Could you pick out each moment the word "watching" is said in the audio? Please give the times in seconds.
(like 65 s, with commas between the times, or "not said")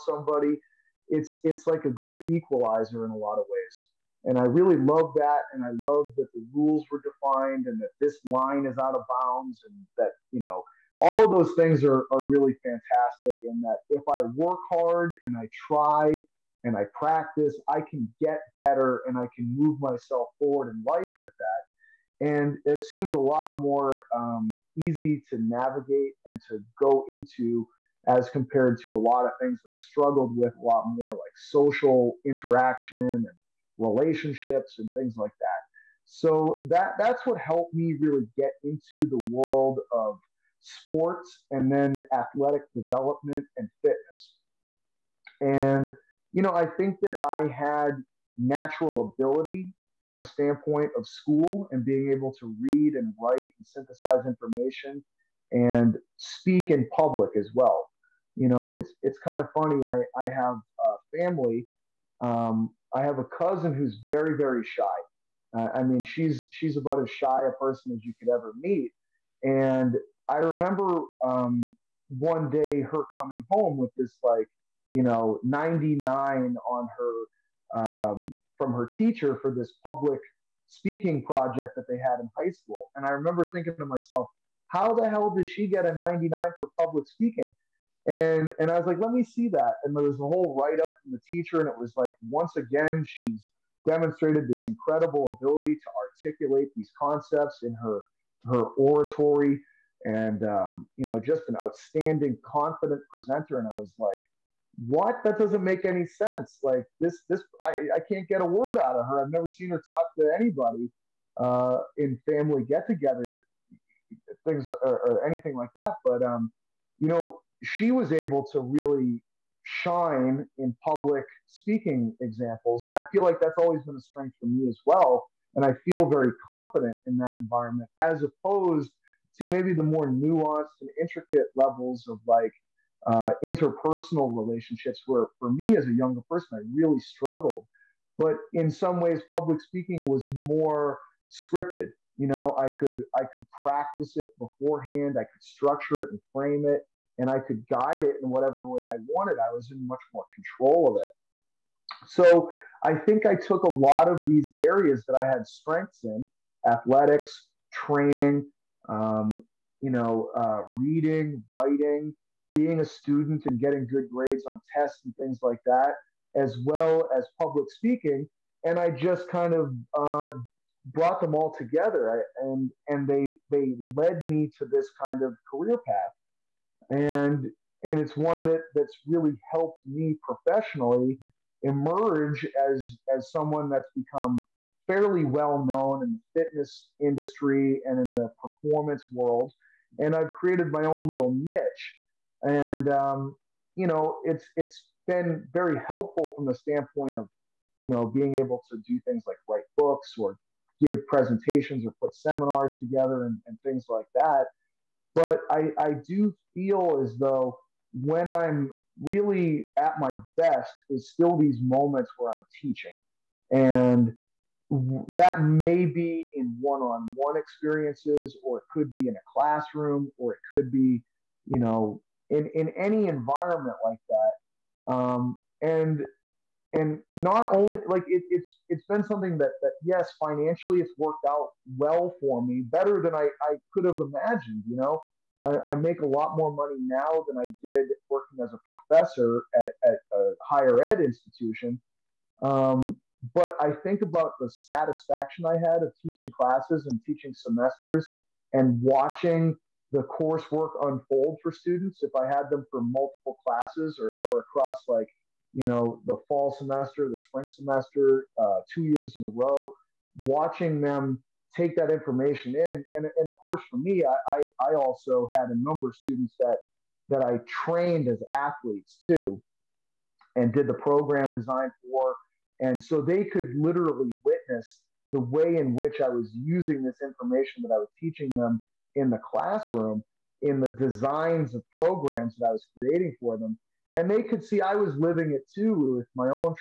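248 s, 260 s.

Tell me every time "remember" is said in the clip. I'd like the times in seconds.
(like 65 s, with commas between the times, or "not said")
70 s, 83 s.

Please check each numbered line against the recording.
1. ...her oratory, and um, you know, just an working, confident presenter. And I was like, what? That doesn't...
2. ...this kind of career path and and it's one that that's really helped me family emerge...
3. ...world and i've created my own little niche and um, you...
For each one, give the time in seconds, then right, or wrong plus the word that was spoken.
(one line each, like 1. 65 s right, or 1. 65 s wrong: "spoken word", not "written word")
1. 98 s wrong: "outstanding", not "working"
2. 174 s wrong: "professionally", not "family"
3. 189 s right.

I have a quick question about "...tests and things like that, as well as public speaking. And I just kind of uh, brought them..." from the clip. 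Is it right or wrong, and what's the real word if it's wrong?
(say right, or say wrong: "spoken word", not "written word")
right.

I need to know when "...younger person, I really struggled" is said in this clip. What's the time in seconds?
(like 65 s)
135 s.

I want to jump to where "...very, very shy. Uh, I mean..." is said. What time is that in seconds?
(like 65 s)
64 s.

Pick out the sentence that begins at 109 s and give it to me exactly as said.
I've never seen her talk to anybody uh, in family get together things or, or anything like that.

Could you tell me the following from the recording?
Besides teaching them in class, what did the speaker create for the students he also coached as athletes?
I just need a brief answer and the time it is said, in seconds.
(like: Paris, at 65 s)
Program design, at 270 s.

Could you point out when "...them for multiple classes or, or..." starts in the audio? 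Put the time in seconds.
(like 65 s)
252 s.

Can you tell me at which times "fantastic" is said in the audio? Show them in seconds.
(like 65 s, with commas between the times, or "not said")
12 s.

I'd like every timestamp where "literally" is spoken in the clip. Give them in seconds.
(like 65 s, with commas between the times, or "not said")
273 s.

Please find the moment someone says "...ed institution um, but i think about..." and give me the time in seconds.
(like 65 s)
240 s.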